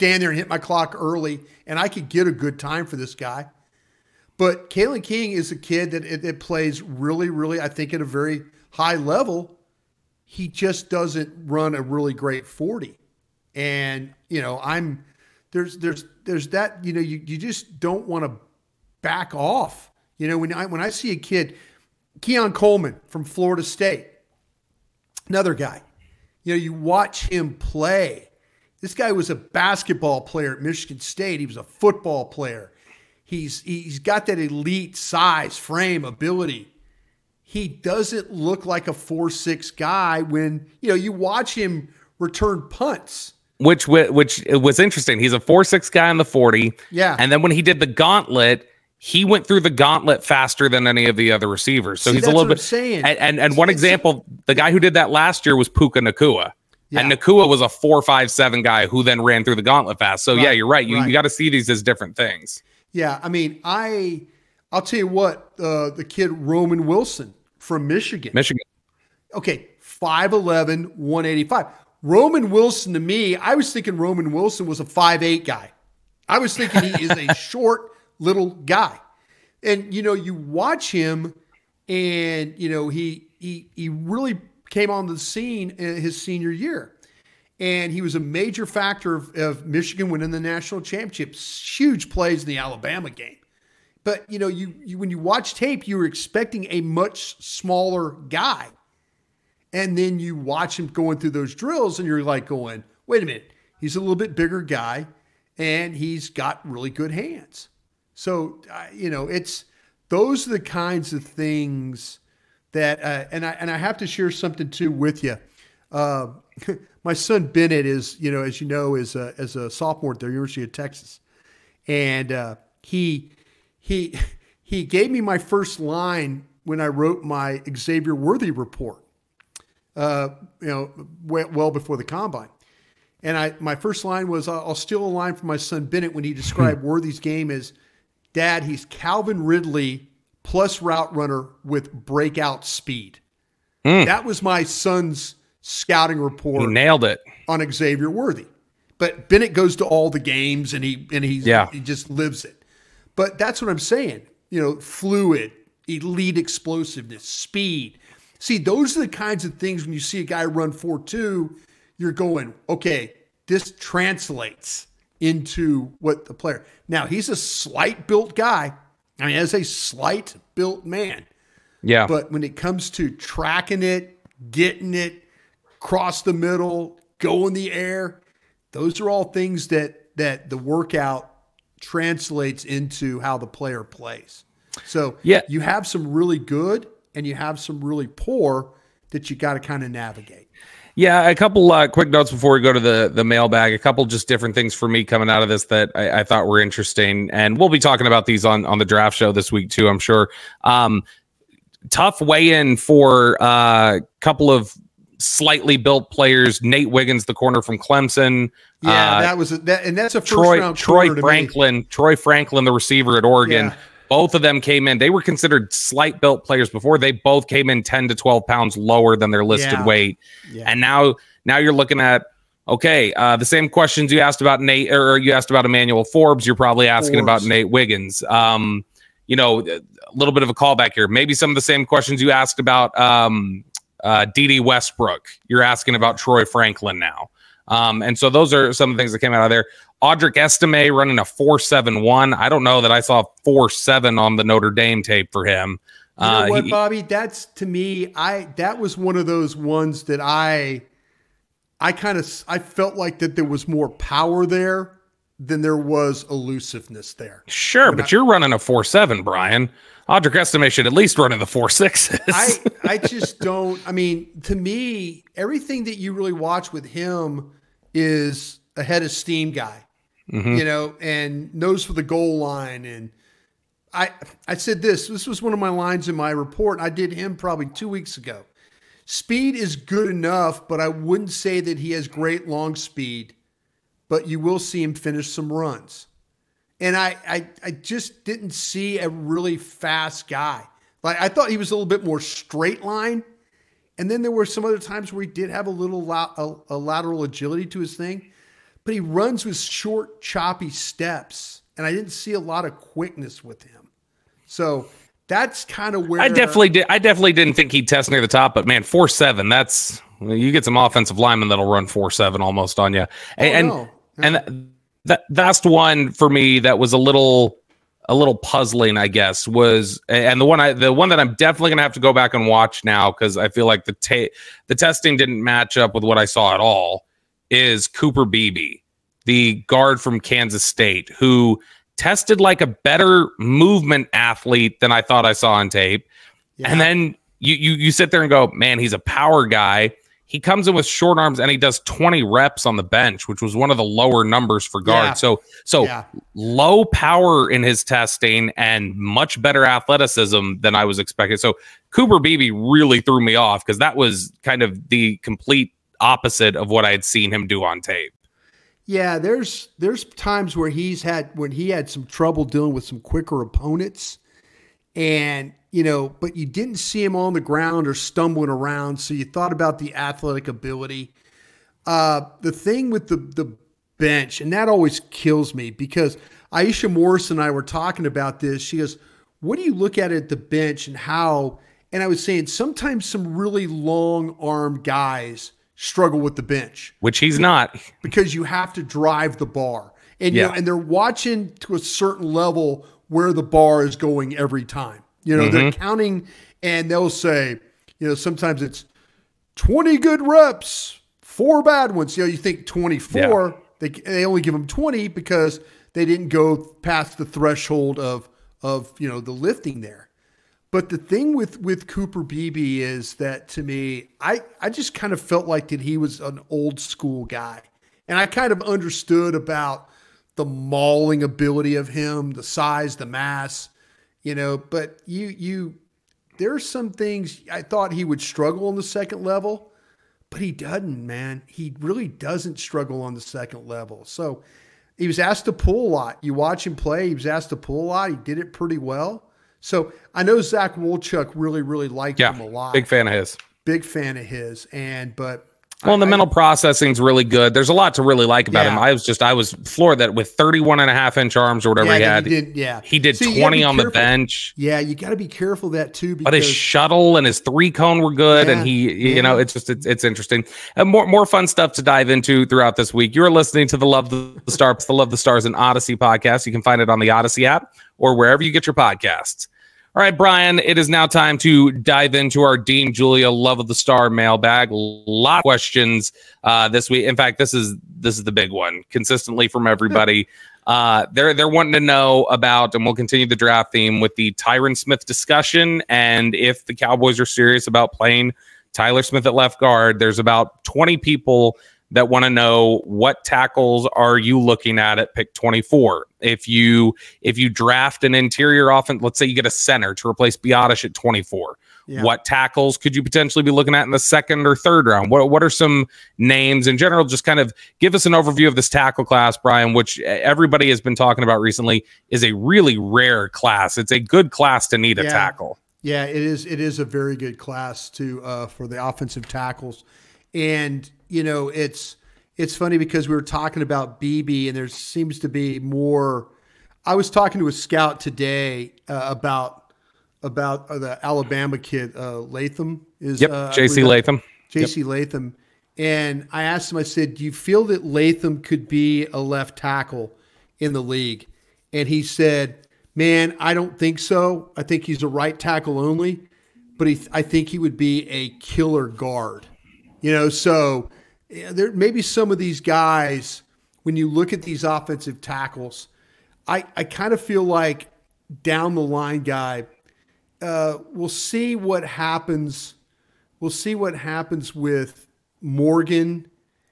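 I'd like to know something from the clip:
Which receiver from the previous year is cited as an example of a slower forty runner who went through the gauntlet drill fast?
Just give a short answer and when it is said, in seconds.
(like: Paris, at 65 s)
Puka Nacua, at 55 s.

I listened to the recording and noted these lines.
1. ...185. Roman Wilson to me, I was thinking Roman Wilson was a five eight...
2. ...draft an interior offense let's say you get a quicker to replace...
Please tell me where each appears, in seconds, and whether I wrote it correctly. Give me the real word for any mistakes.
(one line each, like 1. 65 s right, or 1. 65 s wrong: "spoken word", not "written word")
1. 70 s right
2. 497 s wrong: "center", not "quicker".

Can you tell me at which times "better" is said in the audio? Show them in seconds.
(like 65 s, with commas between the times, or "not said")
332 s, 349 s.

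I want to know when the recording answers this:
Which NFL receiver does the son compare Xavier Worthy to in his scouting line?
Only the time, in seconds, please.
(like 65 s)
138 s.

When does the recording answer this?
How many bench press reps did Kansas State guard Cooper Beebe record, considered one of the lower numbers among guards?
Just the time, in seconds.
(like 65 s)
341 s.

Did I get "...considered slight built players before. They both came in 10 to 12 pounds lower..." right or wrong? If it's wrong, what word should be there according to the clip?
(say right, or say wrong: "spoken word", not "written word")
right.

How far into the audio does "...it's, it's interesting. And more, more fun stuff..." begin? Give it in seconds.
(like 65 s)
459 s.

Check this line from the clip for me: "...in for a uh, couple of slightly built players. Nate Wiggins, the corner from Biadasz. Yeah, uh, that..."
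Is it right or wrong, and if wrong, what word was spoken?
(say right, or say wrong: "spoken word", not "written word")
wrong: "Clemson", not "Biadasz".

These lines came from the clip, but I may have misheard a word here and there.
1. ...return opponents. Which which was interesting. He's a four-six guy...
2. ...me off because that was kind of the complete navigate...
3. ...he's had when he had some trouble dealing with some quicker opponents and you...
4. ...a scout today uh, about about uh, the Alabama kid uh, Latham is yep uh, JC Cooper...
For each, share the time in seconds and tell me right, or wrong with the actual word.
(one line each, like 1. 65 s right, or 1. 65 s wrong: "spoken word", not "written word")
1. 42 s wrong: "punts", not "opponents"
2. 353 s wrong: "opposite", not "navigate"
3. 360 s right
4. 527 s wrong: "Latham", not "Cooper".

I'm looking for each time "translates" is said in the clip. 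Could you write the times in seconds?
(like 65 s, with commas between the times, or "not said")
163 s, 181 s.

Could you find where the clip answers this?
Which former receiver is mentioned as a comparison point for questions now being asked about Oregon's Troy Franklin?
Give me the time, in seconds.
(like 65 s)
234 s.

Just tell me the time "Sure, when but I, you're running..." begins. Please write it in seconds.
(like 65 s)
257 s.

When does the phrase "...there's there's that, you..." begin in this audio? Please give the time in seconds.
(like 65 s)
15 s.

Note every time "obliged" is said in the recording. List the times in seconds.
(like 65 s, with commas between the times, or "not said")
not said.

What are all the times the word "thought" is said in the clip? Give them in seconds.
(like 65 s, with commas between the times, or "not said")
196 s, 291 s, 335 s, 369 s, 427 s.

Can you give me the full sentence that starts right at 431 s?
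He really doesn't struggle on the second level.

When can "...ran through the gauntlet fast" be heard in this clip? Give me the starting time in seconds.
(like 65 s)
59 s.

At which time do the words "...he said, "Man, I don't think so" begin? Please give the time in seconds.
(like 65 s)
541 s.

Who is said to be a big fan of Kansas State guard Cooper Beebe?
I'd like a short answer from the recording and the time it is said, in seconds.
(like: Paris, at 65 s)
Zach Wolchuk, at 440 s.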